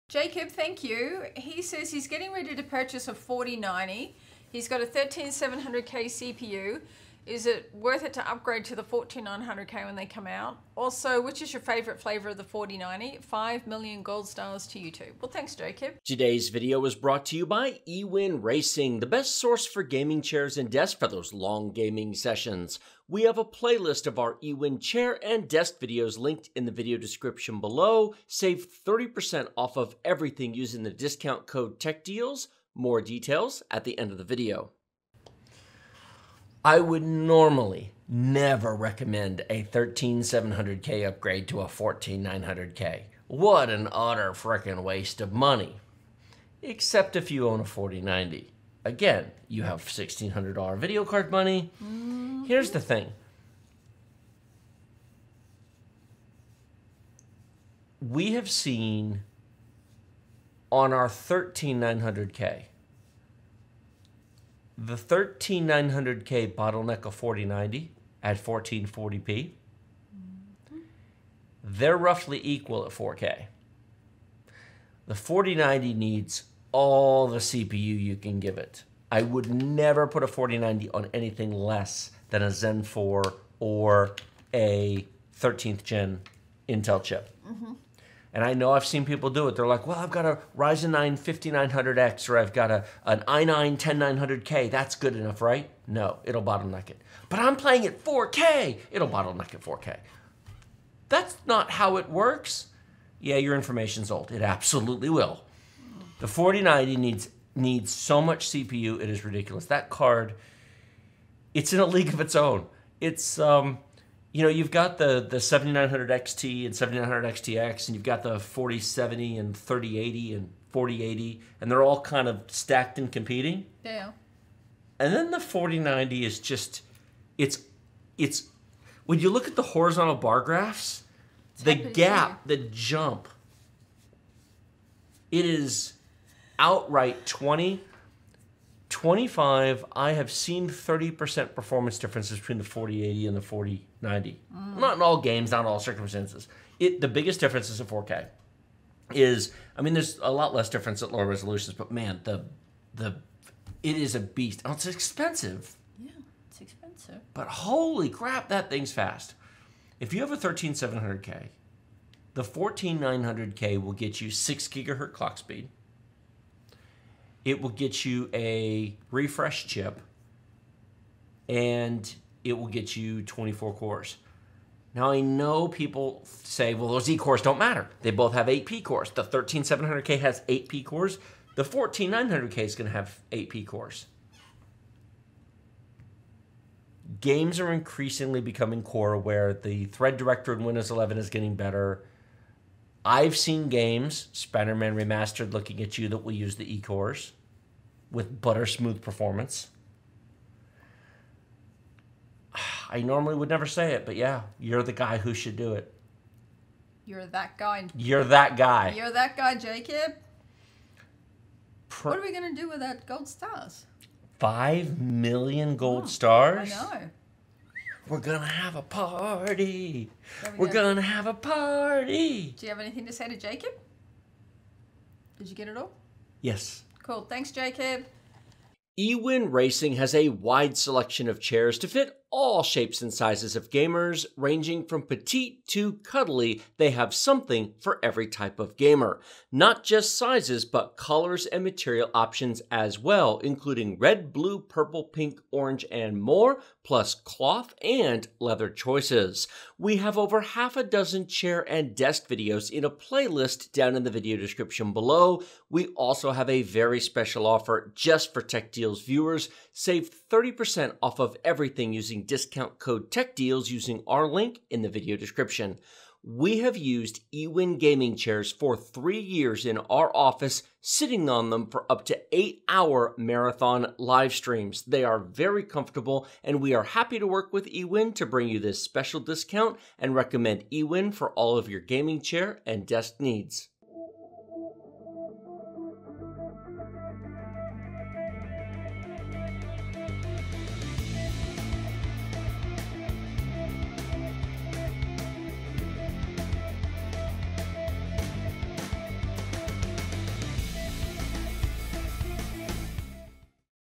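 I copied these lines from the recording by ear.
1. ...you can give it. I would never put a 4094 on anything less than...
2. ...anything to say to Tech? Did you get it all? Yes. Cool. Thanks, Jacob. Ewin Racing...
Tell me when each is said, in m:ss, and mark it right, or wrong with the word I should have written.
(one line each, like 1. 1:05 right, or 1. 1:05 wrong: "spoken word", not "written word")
1. 1:18 wrong: "4090", not "4094"
2. 3:42 wrong: "Jacob", not "Tech".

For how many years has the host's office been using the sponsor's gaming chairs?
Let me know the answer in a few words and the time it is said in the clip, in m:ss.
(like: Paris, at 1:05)
3, at 4:28.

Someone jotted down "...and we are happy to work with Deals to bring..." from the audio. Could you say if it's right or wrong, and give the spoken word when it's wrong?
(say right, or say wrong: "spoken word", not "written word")
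wrong: "Ewin", not "Deals".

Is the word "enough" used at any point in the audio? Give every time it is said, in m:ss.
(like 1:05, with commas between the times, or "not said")
1:35.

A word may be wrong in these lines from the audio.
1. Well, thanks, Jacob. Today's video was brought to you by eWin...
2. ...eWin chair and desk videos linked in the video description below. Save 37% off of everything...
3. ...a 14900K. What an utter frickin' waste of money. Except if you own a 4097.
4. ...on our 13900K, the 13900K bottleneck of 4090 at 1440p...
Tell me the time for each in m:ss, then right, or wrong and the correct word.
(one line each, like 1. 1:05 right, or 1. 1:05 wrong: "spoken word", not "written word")
1. 0:15 right
2. 0:24 wrong: "30", not "37"
3. 0:41 wrong: "4090", not "4097"
4. 1:00 right.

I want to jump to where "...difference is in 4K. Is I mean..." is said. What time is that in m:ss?
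2:27.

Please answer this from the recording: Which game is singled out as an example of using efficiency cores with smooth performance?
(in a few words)
Spider Man Remastered.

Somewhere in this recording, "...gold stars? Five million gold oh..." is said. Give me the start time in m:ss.
3:33.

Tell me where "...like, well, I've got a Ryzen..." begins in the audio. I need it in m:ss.
1:29.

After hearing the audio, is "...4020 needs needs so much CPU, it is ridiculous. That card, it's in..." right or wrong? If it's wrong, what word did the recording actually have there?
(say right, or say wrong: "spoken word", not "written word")
wrong: "4090", not "4020".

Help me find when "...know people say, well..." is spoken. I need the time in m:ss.
2:55.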